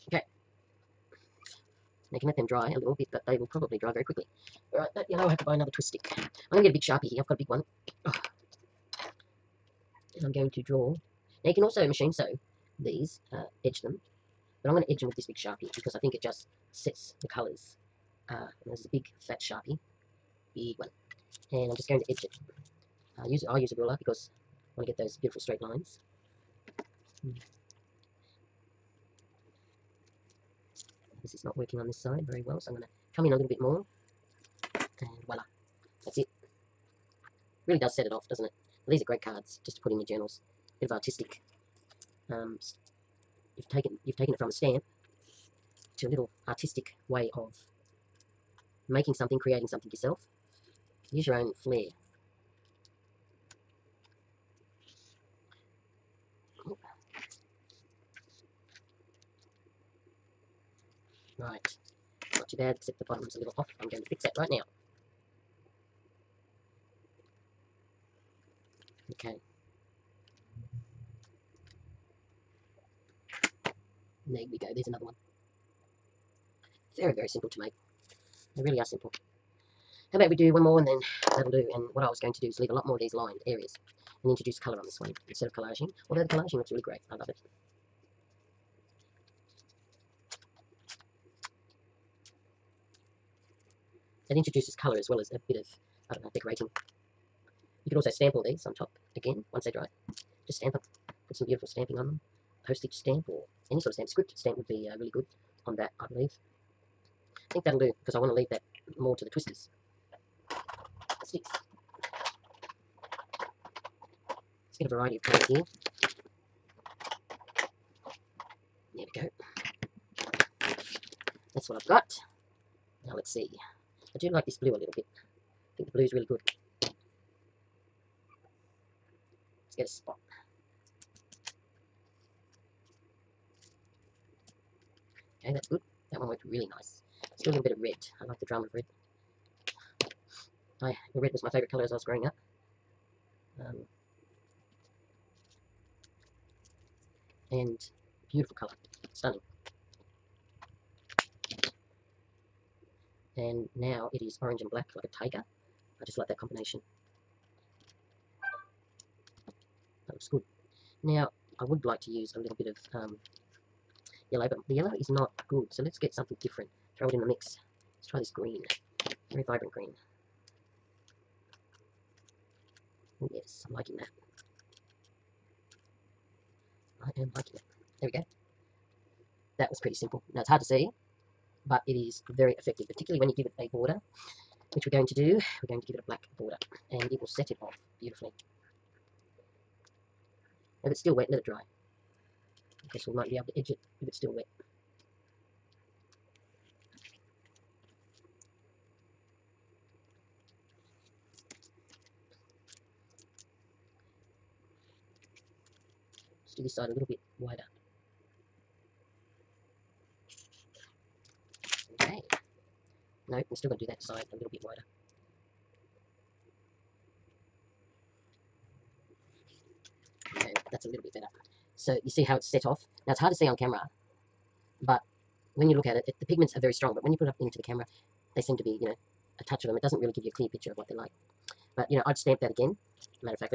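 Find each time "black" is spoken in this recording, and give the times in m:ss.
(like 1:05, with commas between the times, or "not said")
2:34, 3:06.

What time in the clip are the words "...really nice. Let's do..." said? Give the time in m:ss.
2:16.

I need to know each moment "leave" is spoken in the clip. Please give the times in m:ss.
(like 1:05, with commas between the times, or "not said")
1:22, 1:48.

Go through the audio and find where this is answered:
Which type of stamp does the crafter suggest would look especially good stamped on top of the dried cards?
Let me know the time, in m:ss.
1:44.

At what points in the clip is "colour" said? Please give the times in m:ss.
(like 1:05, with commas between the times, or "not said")
0:17, 1:24, 1:34, 1:55, 2:21, 2:28.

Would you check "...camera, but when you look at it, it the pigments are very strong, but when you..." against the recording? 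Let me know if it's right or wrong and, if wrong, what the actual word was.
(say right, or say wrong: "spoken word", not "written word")
right.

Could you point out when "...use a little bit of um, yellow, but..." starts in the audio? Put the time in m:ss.
2:42.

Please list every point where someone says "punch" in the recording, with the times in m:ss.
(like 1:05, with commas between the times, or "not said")
not said.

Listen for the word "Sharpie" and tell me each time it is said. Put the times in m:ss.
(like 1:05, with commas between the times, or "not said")
0:06, 0:15, 0:19.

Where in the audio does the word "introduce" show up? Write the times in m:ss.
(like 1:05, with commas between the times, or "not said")
1:24, 1:34.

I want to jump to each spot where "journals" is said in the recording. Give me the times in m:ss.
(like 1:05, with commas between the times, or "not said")
0:40.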